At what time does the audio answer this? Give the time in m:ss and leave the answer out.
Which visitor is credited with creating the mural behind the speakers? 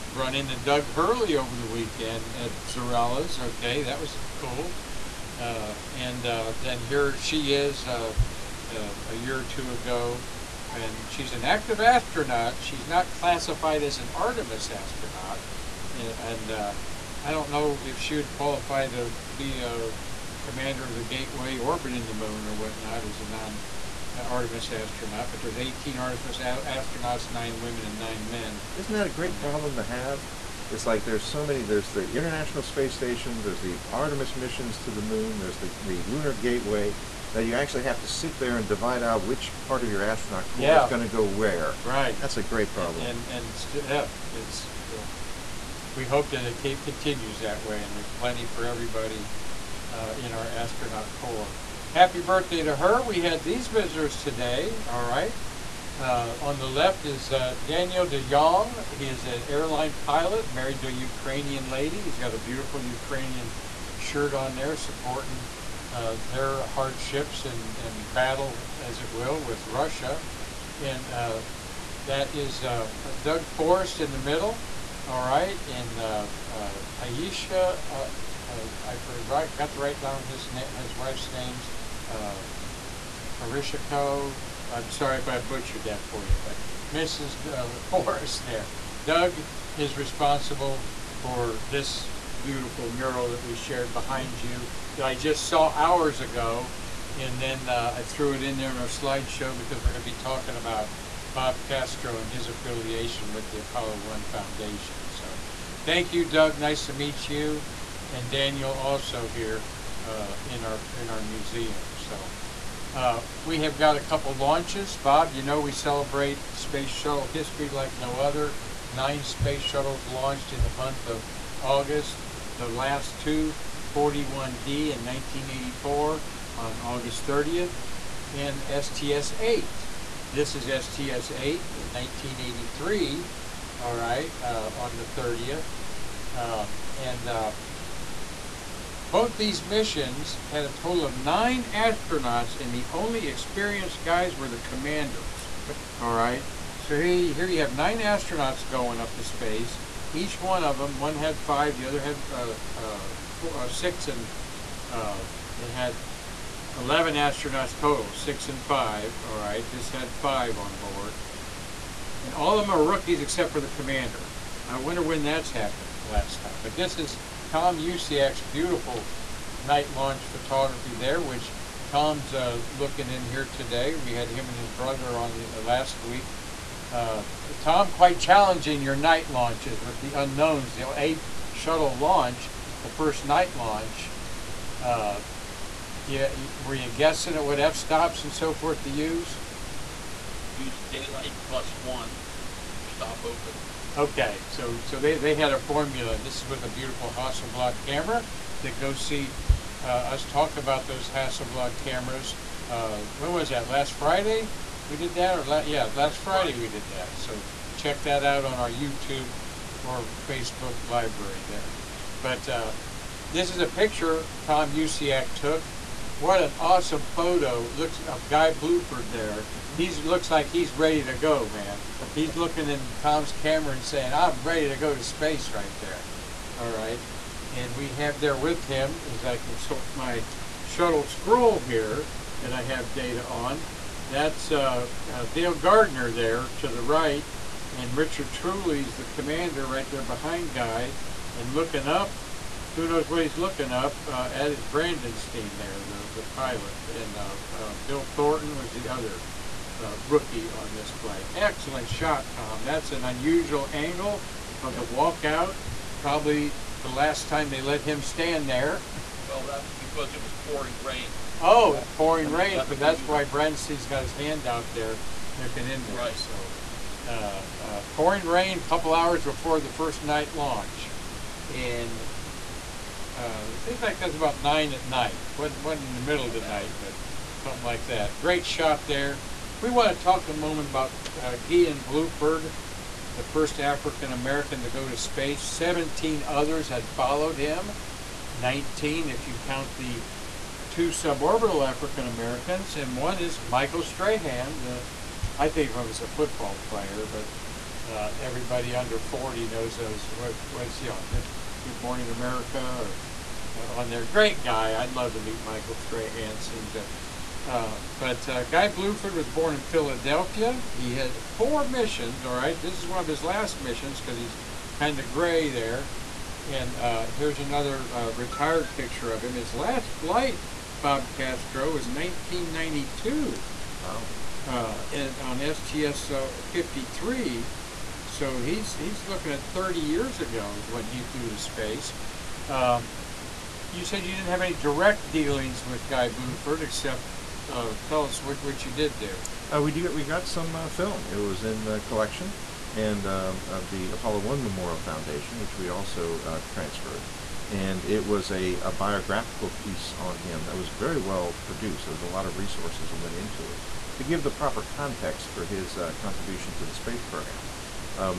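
1:13.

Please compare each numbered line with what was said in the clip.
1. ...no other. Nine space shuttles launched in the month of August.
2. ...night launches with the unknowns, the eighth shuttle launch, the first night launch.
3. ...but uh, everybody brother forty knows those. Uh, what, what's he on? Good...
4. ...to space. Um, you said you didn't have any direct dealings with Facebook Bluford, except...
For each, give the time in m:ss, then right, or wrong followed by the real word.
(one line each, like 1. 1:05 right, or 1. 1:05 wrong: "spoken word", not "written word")
1. 1:57 right
2. 2:58 right
3. 4:57 wrong: "under", not "brother"
4. 5:31 wrong: "Guy", not "Facebook".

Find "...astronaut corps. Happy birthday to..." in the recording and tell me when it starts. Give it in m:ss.
0:50.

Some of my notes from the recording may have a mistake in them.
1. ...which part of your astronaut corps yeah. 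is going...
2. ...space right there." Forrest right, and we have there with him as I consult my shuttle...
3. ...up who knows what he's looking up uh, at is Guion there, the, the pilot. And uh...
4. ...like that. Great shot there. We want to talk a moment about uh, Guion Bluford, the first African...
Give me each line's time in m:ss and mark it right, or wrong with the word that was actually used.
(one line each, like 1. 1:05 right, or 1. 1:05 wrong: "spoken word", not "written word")
1. 0:39 right
2. 3:45 wrong: "All", not "Forrest"
3. 4:01 wrong: "Brandenstein", not "Guion"
4. 4:37 right.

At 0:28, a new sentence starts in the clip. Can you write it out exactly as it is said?
Isn't that a great uh, problem to have?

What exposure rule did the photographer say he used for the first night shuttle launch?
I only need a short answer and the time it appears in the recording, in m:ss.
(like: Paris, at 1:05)
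Daylight plus one stop, at 3:10.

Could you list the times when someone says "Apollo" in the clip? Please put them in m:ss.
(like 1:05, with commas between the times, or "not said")
1:43, 5:43.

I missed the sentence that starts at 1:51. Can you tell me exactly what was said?
So uh, we have got a couple launches.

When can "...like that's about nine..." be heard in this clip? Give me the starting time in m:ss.
4:33.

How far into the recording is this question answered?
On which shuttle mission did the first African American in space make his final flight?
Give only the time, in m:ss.
5:25.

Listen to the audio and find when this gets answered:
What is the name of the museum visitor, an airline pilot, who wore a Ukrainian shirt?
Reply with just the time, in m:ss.
0:57.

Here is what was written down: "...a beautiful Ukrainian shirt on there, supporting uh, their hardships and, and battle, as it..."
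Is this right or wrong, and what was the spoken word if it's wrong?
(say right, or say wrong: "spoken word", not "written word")
right.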